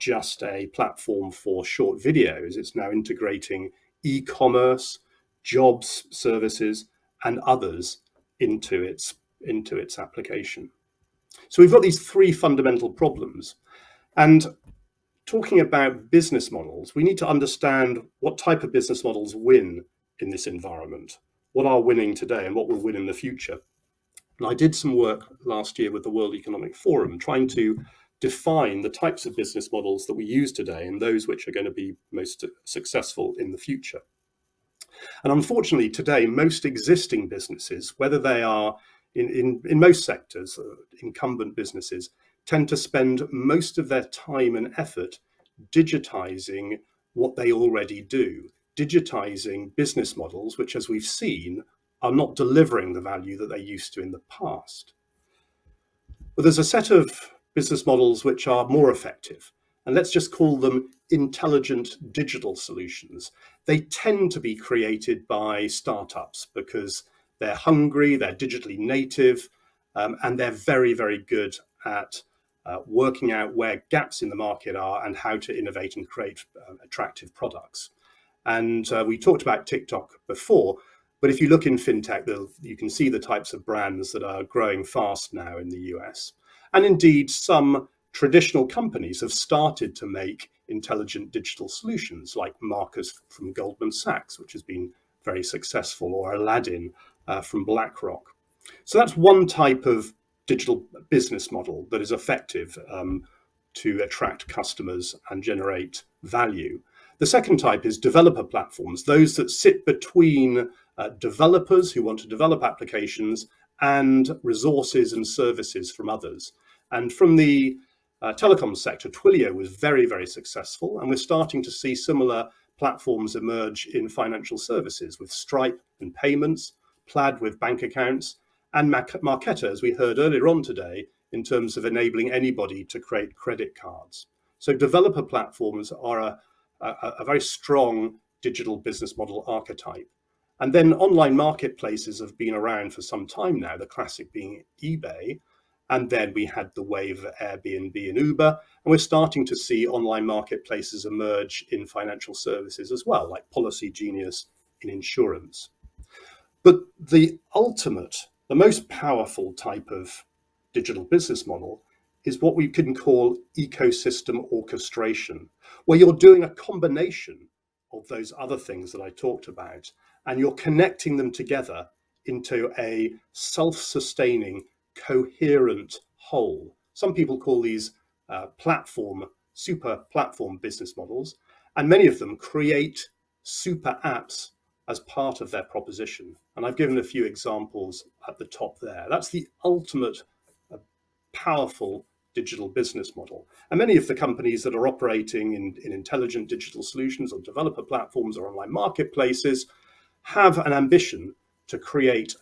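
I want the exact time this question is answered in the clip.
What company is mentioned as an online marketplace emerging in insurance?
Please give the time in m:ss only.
2:33.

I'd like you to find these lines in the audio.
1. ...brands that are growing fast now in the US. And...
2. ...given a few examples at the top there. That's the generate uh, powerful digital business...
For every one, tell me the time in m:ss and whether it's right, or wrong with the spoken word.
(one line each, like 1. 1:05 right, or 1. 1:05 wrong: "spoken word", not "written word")
1. 1:23 right
2. 3:06 wrong: "ultimate", not "generate".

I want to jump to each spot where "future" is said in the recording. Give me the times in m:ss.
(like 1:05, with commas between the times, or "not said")
0:23, 0:33.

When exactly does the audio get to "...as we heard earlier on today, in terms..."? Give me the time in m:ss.
2:09.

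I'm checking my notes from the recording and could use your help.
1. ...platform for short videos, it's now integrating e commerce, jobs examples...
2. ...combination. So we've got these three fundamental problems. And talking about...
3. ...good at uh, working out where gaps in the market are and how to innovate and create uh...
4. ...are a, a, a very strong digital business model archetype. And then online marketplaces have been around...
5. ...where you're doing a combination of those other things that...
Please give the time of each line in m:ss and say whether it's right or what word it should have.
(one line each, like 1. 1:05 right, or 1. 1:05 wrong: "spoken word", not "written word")
1. 0:00 wrong: "services", not "examples"
2. 0:09 wrong: "application", not "combination"
3. 1:11 right
4. 2:15 right
5. 2:45 right.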